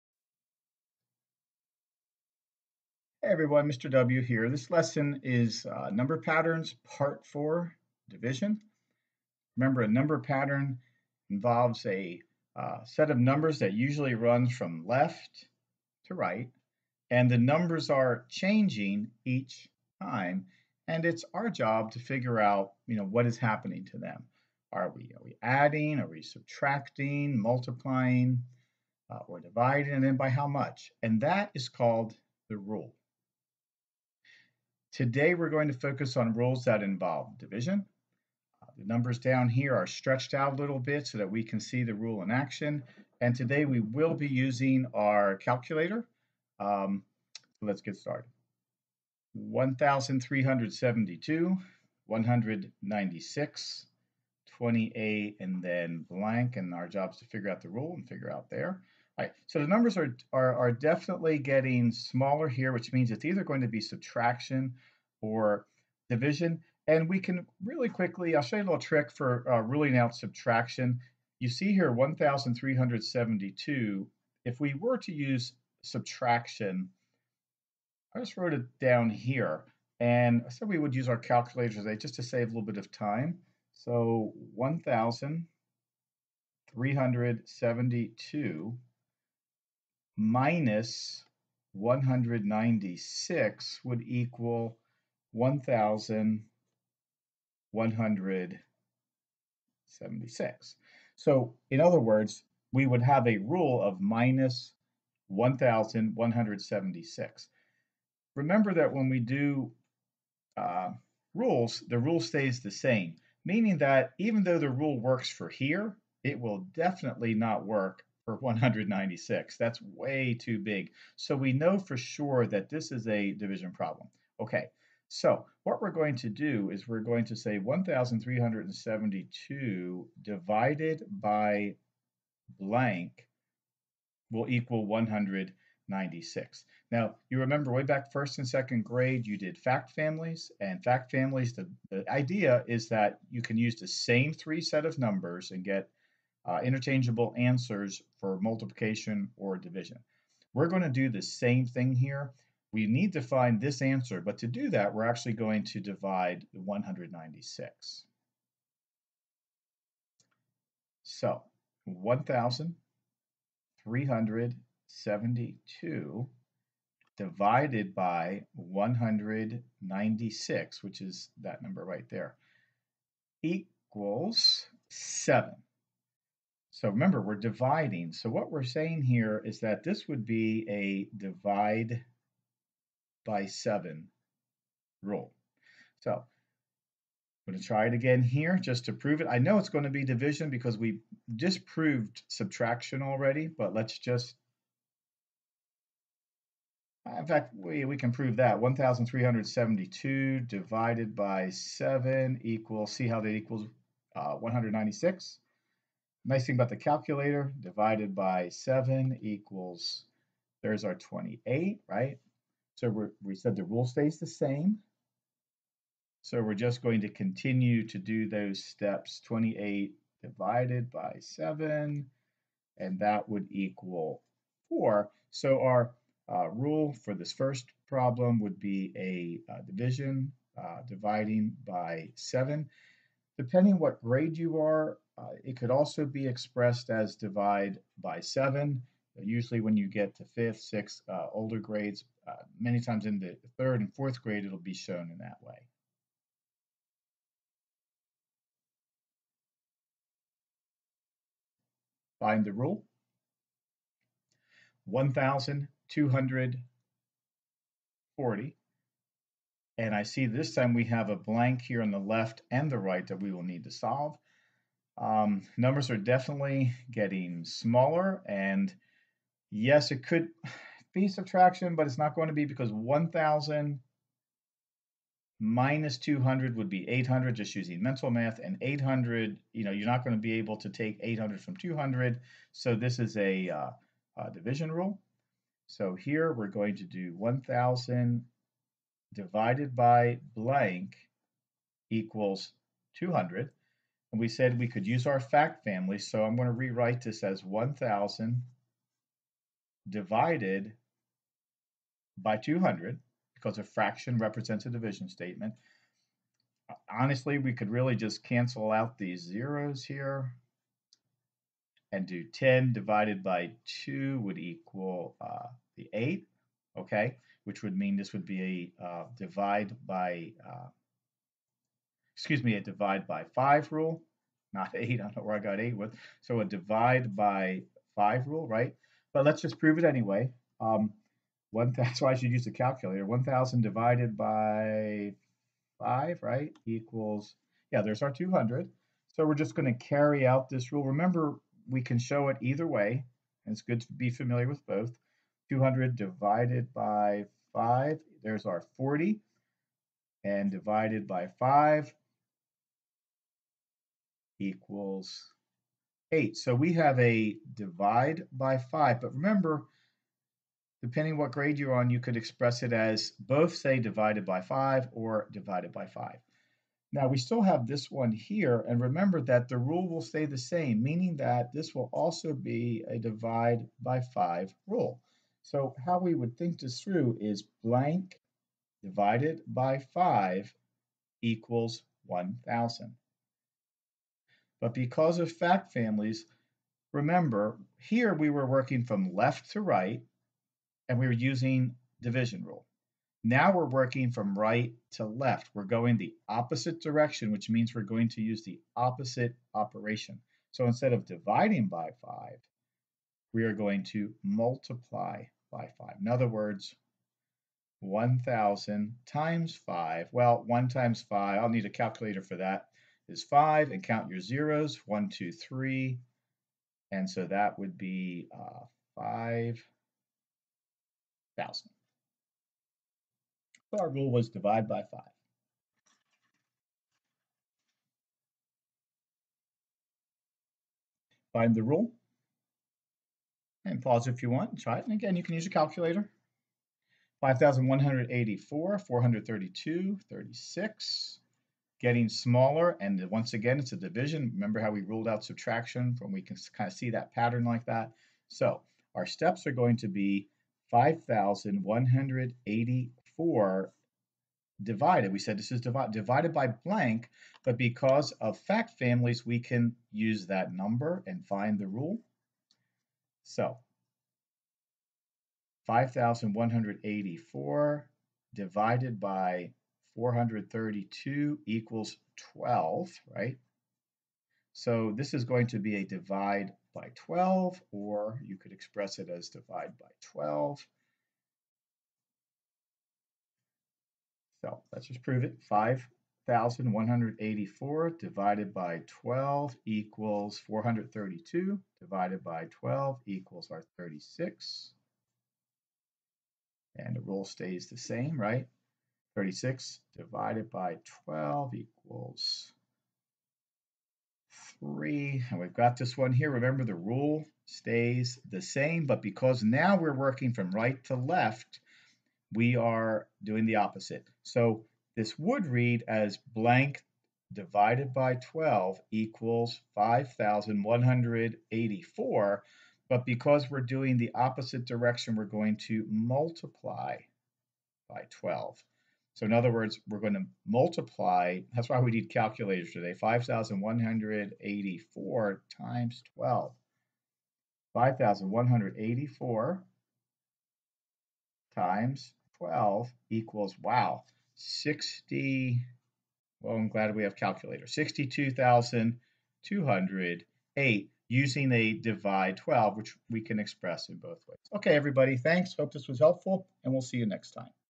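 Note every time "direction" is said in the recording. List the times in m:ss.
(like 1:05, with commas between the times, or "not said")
6:36, 8:44.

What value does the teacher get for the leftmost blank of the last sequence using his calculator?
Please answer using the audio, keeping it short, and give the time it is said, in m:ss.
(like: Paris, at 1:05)
62,208, at 9:07.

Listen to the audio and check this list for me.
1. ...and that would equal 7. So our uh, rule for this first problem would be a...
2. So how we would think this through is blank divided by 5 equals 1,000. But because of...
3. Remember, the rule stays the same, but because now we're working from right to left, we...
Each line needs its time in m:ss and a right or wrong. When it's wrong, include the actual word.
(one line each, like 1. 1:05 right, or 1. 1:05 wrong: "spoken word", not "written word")
1. 3:42 wrong: "4", not "7"
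2. 6:15 right
3. 8:26 right.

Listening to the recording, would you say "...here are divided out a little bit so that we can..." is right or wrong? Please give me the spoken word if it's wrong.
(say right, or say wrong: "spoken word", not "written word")
wrong: "stretched", not "divided".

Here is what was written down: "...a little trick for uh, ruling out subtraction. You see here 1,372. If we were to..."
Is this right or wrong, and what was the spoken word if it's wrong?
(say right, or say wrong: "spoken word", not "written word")
right.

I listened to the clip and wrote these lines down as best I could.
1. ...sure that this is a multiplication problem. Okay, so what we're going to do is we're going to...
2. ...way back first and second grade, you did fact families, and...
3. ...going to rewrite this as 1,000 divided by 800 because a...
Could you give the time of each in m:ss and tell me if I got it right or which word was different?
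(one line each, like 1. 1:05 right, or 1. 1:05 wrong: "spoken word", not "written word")
1. 2:01 wrong: "division", not "multiplication"
2. 2:17 right
3. 4:56 wrong: "200", not "800".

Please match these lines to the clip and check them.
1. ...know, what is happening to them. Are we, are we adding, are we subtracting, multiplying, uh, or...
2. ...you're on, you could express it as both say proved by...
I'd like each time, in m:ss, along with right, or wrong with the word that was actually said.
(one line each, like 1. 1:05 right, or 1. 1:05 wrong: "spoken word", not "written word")
1. 0:22 right
2. 6:01 wrong: "divided", not "proved".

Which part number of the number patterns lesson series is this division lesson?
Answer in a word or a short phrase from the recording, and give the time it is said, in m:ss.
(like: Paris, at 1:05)
4, at 0:06.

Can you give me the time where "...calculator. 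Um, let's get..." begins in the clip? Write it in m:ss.
0:45.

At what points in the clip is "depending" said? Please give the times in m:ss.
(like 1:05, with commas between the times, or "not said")
3:53, 6:00.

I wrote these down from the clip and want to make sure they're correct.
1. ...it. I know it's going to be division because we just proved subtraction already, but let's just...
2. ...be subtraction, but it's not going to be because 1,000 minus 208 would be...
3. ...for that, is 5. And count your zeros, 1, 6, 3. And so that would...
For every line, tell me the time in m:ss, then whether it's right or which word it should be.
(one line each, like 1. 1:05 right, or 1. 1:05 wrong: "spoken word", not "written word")
1. 3:09 right
2. 4:30 wrong: "200", not "208"
3. 6:52 wrong: "2", not "6".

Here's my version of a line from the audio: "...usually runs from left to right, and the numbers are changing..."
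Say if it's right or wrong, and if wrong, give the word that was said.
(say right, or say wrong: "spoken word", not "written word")
right.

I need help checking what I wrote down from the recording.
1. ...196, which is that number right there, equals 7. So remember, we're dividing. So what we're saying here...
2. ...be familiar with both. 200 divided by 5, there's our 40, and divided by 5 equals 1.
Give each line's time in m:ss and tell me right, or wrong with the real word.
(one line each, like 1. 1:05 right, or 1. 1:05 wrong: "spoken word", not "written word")
1. 2:48 right
2. 5:43 wrong: "8", not "1".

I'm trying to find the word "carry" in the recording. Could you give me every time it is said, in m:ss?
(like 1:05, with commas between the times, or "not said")
5:39.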